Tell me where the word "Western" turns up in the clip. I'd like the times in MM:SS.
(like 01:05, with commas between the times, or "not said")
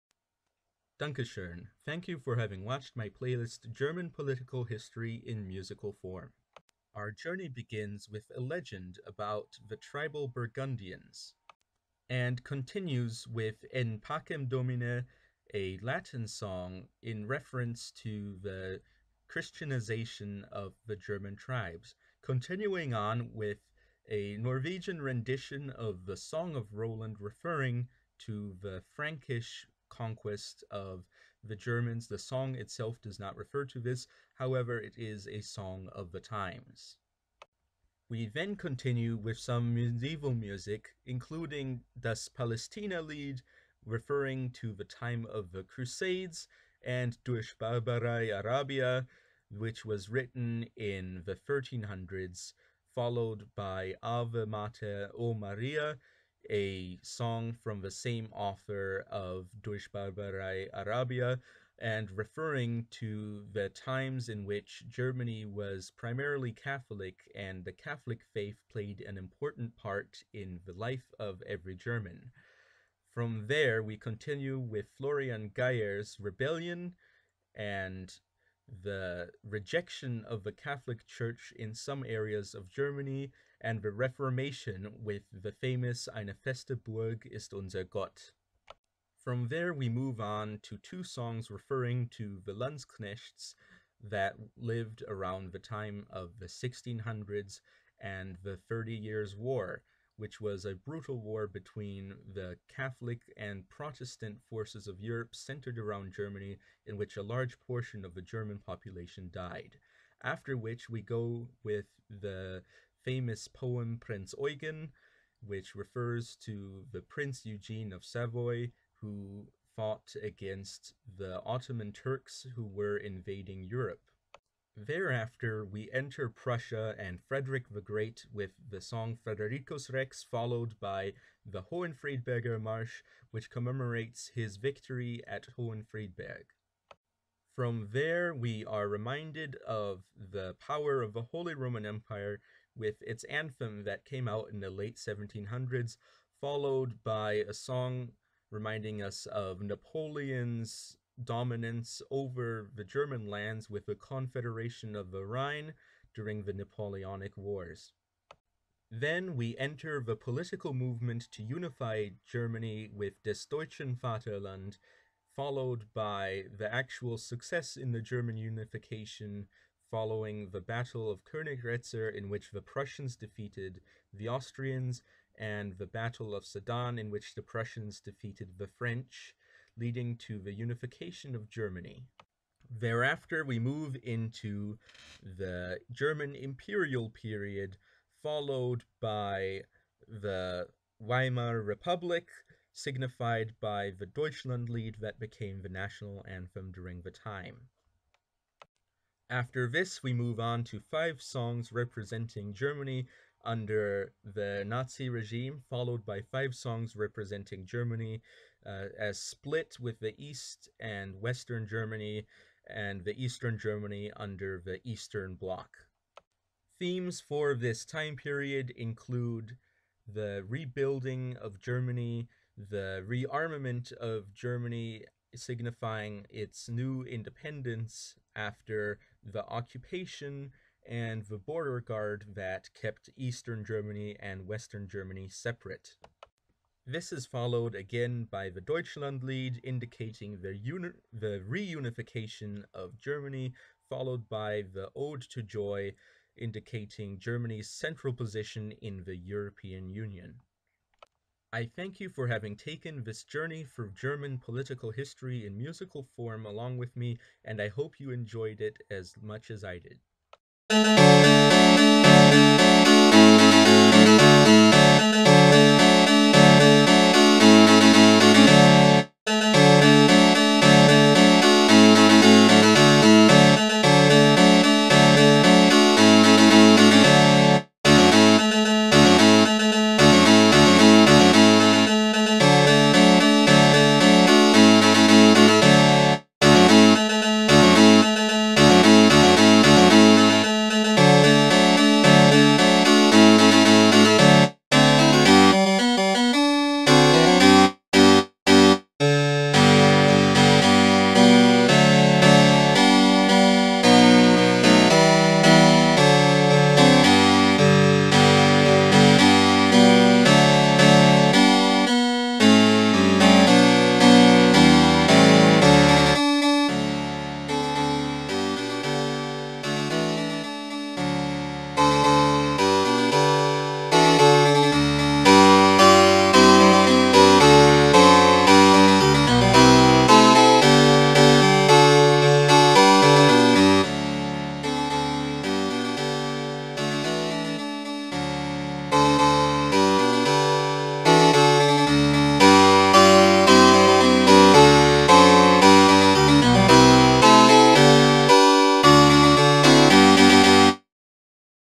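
03:31, 03:54.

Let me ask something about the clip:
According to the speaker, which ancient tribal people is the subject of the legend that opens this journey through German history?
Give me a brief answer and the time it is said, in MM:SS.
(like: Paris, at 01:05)
Burgundians, at 00:10.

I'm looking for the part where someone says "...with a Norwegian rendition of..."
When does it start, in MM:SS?
00:23.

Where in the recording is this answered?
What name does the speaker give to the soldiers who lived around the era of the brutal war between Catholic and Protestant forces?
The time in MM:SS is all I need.
01:32.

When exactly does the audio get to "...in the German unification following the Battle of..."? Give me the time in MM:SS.
02:47.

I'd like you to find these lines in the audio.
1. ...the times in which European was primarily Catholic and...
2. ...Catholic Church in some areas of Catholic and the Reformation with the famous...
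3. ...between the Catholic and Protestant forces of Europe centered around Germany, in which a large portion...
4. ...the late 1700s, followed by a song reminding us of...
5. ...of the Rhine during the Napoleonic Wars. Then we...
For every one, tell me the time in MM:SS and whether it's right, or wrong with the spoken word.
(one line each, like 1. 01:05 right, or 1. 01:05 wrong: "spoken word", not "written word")
1. 01:03 wrong: "Germany", not "European"
2. 01:20 wrong: "Germany", not "Catholic"
3. 01:41 right
4. 02:24 right
5. 02:34 right.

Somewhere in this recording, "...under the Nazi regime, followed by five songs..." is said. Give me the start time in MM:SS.
03:23.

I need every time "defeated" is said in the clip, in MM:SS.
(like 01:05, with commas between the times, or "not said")
02:53, 02:58.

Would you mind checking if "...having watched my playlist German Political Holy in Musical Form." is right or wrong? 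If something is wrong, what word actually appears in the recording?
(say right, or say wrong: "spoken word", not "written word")
wrong: "History", not "Holy".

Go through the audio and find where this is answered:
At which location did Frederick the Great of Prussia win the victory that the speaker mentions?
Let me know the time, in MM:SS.
02:15.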